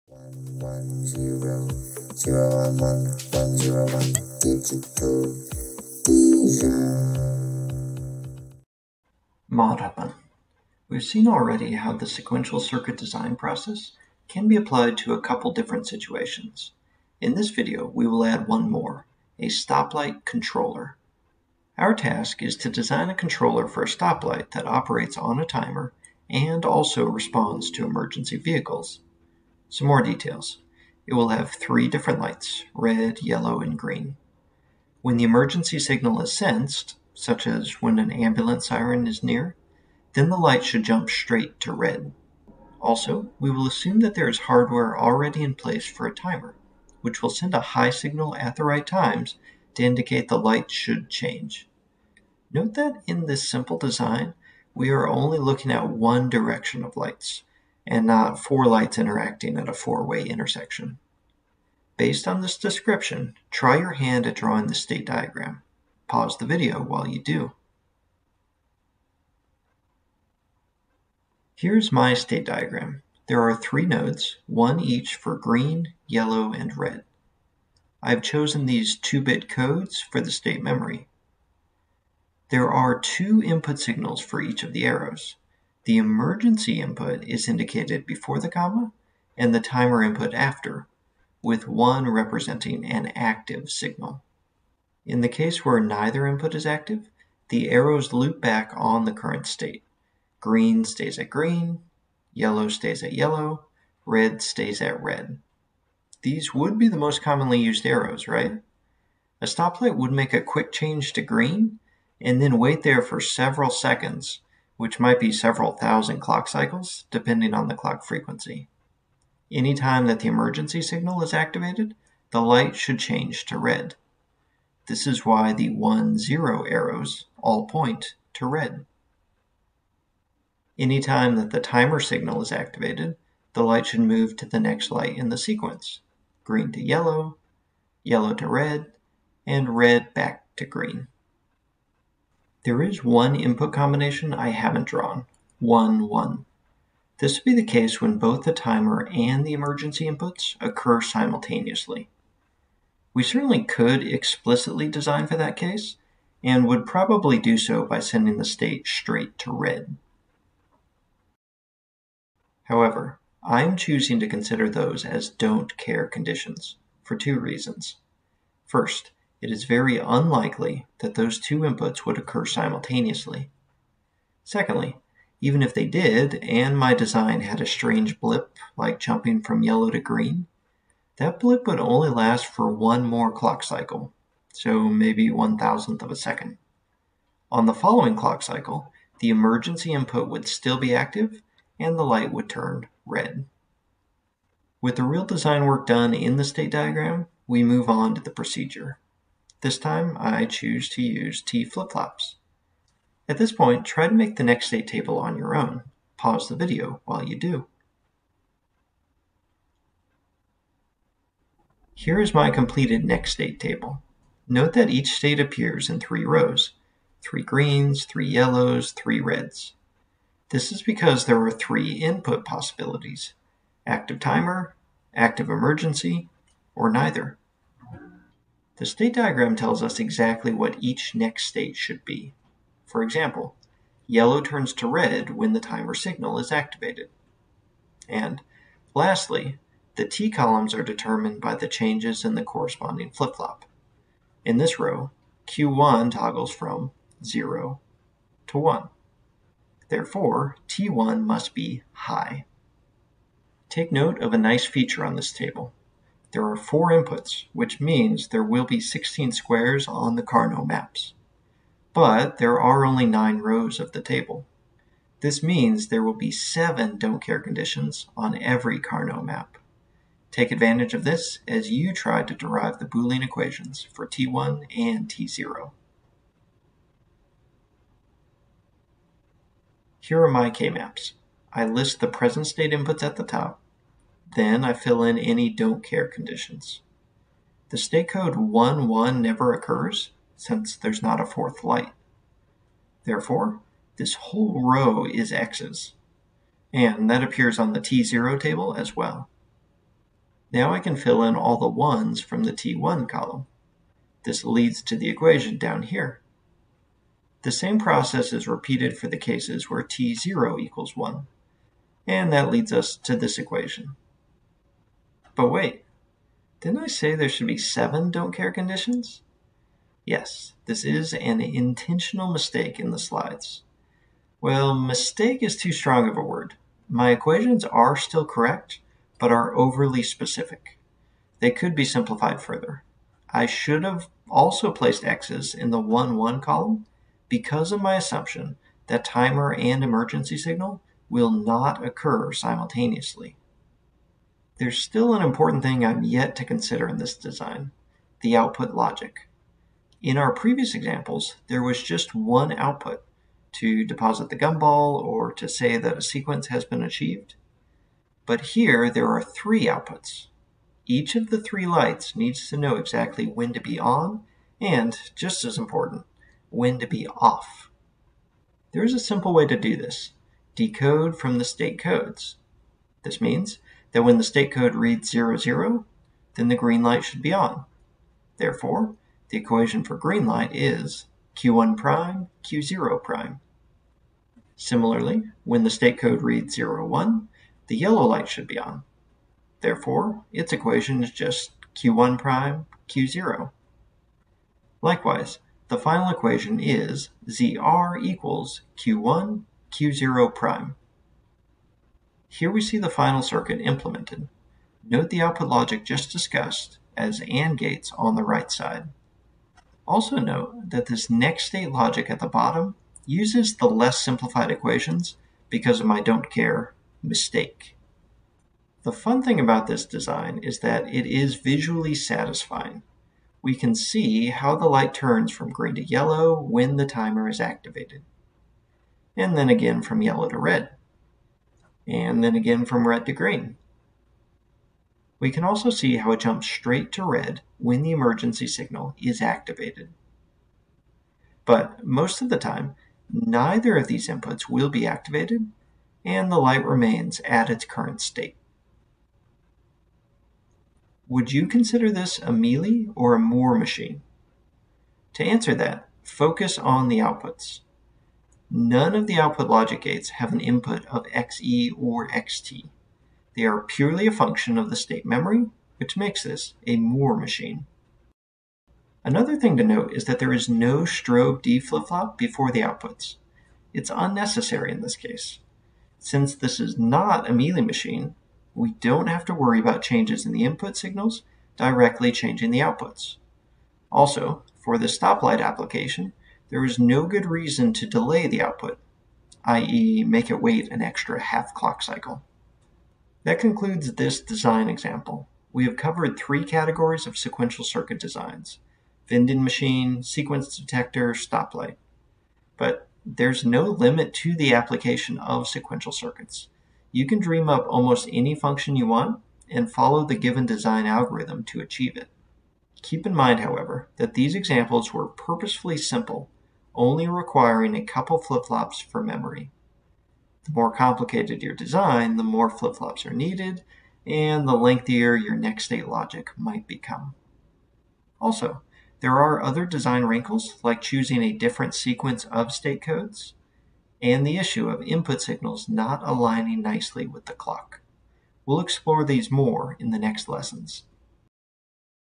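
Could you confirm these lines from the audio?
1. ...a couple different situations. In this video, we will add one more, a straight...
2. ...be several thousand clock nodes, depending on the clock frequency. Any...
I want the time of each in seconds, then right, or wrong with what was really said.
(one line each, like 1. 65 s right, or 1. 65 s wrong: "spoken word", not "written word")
1. 15 s wrong: "stoplight", not "straight"
2. 115 s wrong: "cycles", not "nodes".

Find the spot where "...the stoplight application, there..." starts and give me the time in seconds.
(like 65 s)
484 s.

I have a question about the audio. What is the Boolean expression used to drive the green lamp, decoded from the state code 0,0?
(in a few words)
Q1' Q0'.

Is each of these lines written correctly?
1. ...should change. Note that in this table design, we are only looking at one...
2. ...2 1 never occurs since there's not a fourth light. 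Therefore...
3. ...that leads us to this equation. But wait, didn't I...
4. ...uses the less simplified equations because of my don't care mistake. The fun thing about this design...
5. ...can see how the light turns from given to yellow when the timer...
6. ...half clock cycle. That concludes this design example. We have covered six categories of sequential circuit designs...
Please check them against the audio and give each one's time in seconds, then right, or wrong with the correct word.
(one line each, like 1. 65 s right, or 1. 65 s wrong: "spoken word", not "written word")
1. 50 s wrong: "simple", not "table"
2. 288 s wrong: "1", not "2"
3. 312 s right
4. 413 s right
5. 423 s wrong: "green", not "given"
6. 491 s wrong: "three", not "six".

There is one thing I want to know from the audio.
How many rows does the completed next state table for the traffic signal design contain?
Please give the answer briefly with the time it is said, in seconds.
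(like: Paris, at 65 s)
9, at 263 s.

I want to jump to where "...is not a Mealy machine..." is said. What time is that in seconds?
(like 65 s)
476 s.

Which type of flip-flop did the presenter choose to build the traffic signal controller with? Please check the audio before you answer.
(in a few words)
T flip-flops.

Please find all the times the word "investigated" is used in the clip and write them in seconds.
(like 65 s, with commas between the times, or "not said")
not said.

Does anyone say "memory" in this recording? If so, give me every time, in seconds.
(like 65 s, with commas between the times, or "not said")
80 s, 465 s, 519 s.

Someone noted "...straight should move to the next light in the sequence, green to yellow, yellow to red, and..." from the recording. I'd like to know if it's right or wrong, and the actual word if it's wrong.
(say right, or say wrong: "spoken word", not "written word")
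wrong: "light", not "straight".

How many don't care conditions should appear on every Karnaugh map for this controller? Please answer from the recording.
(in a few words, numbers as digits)
7.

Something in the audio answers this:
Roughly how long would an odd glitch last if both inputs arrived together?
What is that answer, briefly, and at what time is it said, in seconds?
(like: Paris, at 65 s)
one thousandth of a second, at 185 s.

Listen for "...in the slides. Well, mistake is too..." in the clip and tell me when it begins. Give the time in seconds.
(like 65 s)
322 s.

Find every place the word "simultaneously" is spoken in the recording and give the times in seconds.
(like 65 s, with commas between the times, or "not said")
151 s, 172 s, 342 s.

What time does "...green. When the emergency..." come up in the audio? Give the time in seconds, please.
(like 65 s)
33 s.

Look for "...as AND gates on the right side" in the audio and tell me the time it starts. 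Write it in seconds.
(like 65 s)
406 s.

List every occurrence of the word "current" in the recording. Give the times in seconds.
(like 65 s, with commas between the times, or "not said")
99 s, 447 s.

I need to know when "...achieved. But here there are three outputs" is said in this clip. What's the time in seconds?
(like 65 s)
356 s.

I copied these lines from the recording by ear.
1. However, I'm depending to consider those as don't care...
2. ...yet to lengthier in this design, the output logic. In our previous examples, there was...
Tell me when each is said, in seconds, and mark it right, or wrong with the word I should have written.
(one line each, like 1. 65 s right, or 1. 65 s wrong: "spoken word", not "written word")
1. 162 s wrong: "choosing", not "depending"
2. 346 s wrong: "consider", not "lengthier".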